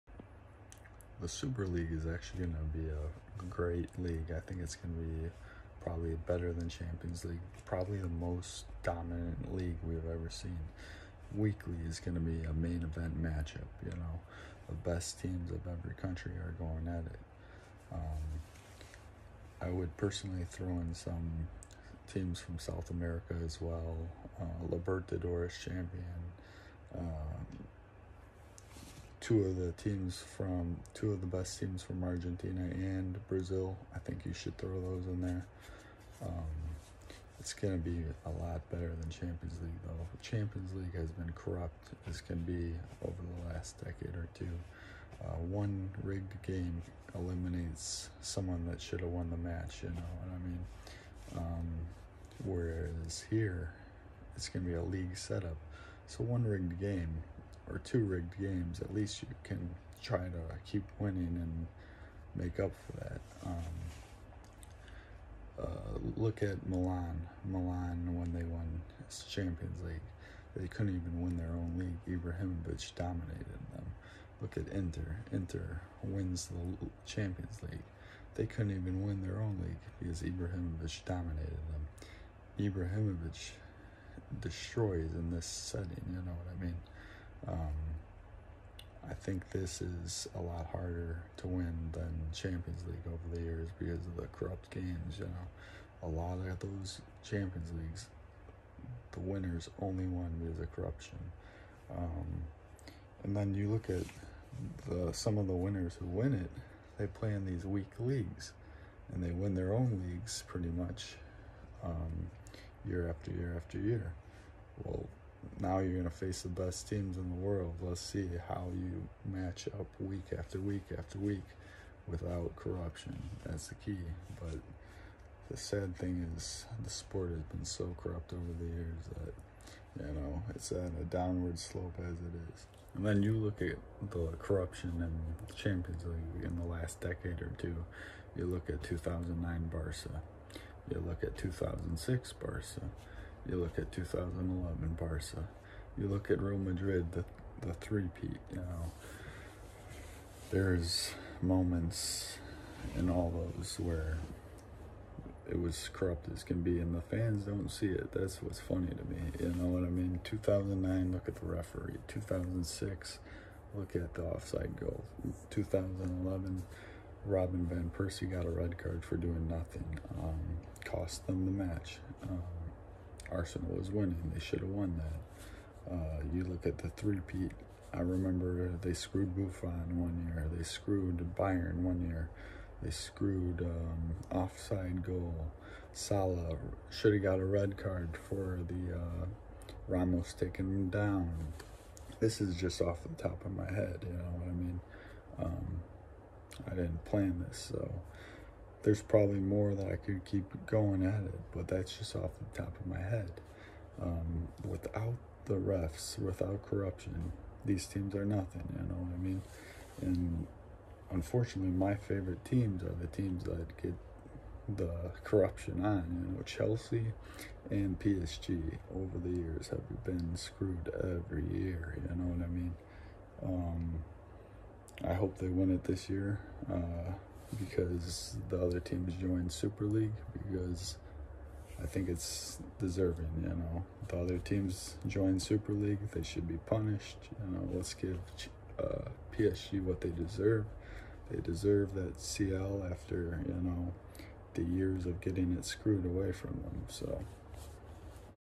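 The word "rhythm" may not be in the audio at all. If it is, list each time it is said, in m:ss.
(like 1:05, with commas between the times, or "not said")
not said.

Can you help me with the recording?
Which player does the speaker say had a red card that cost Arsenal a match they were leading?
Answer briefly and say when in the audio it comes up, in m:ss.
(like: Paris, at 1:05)
Robin Van Persie, at 2:47.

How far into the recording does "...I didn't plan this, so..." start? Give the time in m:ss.
3:16.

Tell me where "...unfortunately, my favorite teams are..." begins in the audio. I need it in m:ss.
3:31.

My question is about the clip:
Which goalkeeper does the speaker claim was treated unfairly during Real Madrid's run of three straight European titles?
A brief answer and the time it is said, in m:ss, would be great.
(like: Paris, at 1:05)
Buffon, at 2:59.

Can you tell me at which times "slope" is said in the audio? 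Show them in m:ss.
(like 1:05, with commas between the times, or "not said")
2:11.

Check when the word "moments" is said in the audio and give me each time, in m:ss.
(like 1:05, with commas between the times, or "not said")
2:31.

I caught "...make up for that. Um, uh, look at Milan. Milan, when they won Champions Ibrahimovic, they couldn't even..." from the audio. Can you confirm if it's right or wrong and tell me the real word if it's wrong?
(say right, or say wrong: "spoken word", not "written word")
wrong: "League", not "Ibrahimovic".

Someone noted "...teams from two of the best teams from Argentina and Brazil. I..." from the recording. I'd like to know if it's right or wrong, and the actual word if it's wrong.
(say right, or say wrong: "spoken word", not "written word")
right.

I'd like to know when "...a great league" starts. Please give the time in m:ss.
0:02.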